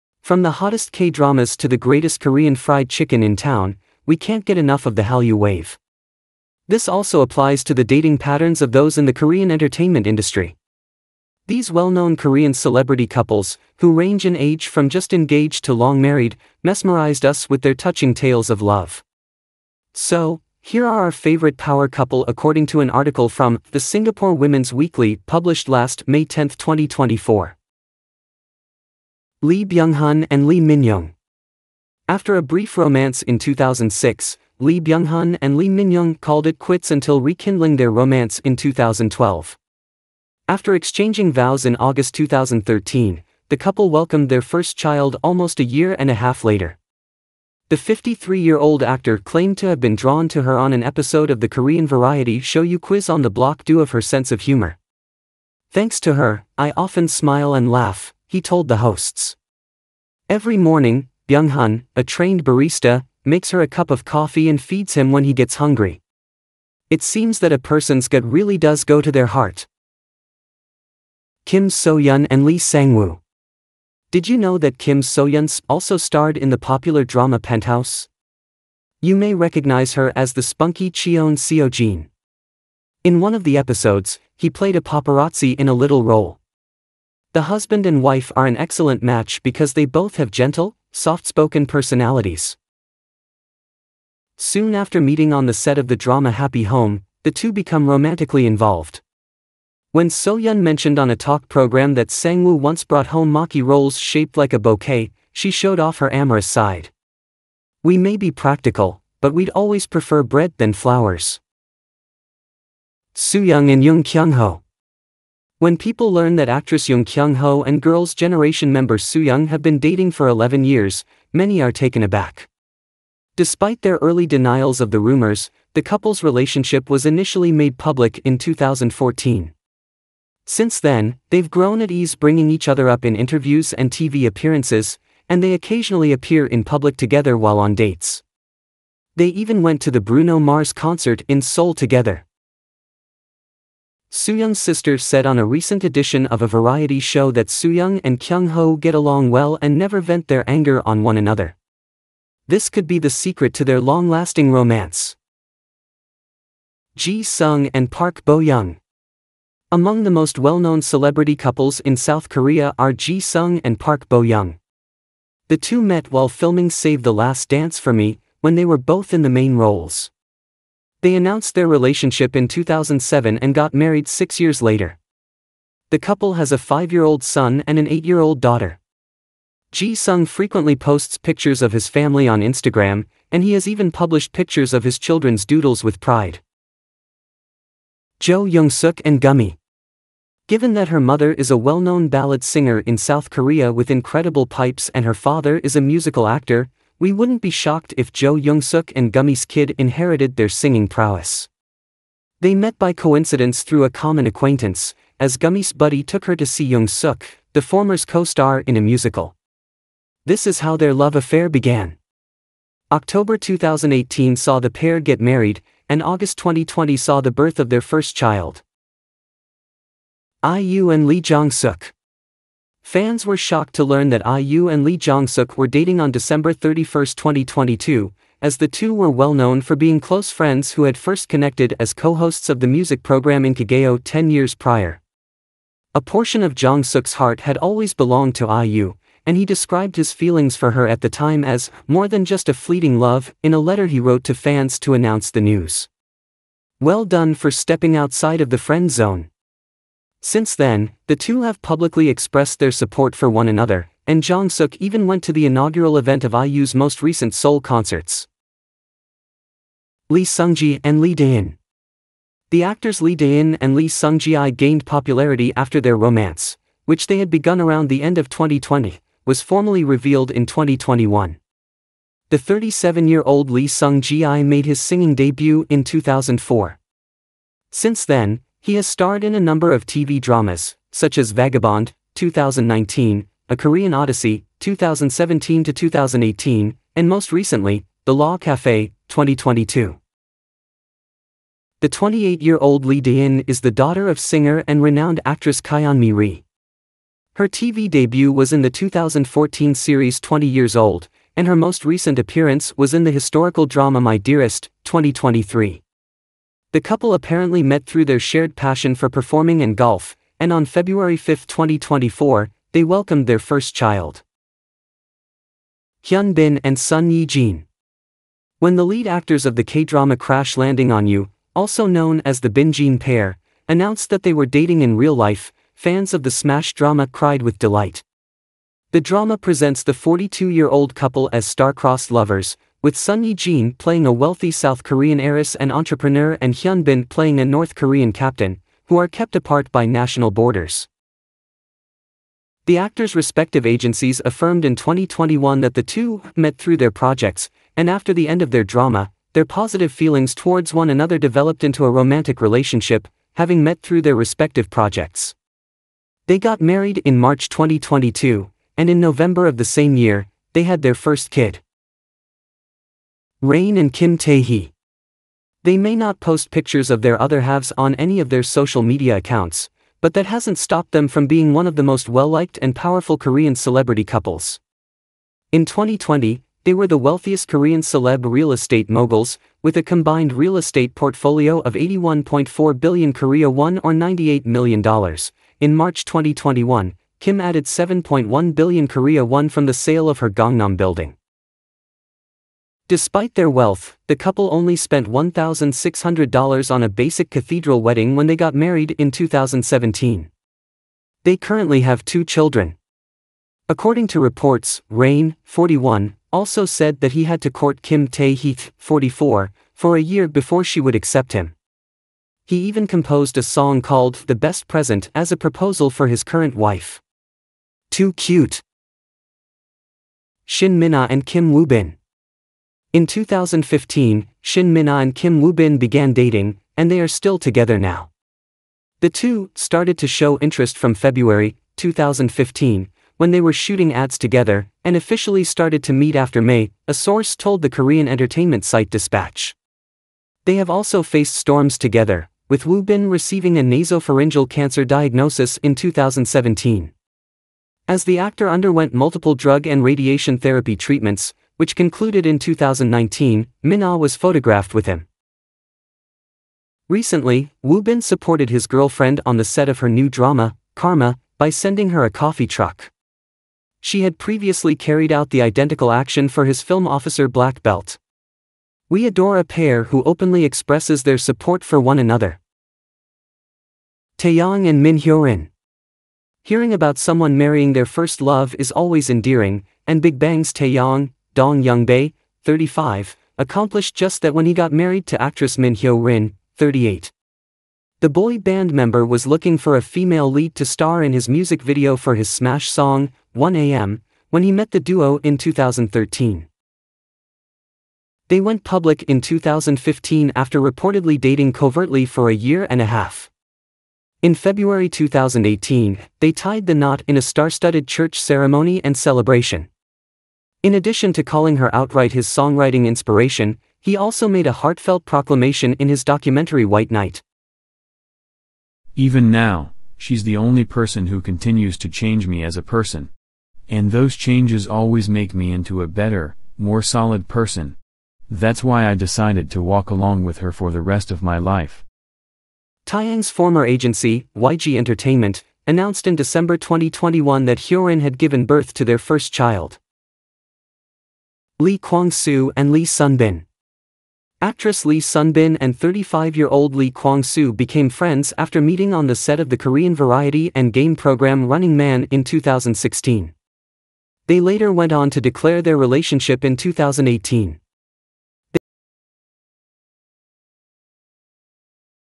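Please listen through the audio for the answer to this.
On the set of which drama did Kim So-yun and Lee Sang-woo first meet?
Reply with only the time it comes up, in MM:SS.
01:36.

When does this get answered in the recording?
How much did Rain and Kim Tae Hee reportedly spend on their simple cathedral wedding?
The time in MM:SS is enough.
06:35.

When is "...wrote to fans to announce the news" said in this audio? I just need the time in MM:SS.
04:03.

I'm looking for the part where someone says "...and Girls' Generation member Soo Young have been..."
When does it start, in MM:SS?
01:57.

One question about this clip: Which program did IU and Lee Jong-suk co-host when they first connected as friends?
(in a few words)
Inkigayo.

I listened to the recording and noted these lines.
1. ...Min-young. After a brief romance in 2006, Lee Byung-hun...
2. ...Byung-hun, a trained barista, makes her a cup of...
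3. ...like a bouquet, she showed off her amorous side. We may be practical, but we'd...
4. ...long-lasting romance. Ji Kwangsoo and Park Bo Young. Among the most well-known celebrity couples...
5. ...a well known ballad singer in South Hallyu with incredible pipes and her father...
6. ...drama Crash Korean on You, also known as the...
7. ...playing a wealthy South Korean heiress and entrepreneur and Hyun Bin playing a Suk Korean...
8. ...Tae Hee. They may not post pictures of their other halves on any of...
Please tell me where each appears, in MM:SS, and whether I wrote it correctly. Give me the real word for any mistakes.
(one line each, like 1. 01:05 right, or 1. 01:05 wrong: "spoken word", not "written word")
1. 00:30 right
2. 01:01 right
3. 01:44 right
4. 02:33 wrong: "Sung", not "Kwangsoo"
5. 03:11 wrong: "Korea", not "Hallyu"
6. 05:19 wrong: "Landing", not "Korean"
7. 05:33 wrong: "North", not "Suk"
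8. 06:04 right.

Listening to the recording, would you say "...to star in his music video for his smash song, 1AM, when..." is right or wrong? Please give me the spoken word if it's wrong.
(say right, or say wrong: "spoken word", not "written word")
right.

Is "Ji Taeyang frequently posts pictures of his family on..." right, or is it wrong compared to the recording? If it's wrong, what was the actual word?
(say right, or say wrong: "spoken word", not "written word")
wrong: "Sung", not "Taeyang".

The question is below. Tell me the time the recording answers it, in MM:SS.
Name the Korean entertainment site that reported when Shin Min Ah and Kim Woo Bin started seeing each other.
07:18.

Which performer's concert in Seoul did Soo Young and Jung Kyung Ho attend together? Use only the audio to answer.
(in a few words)
Bruno Mars.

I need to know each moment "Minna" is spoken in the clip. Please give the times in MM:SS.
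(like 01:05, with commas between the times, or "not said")
07:00, 07:33.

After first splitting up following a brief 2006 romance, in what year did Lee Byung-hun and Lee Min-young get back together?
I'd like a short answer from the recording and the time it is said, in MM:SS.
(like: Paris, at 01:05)
2012, at 00:38.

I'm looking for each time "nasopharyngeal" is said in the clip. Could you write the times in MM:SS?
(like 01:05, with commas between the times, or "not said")
07:23.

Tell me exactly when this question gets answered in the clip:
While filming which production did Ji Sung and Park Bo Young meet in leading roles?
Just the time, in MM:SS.
02:46.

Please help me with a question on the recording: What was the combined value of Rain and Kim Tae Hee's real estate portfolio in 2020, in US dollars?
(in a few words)
$98 million.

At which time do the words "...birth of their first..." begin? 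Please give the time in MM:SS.
03:37.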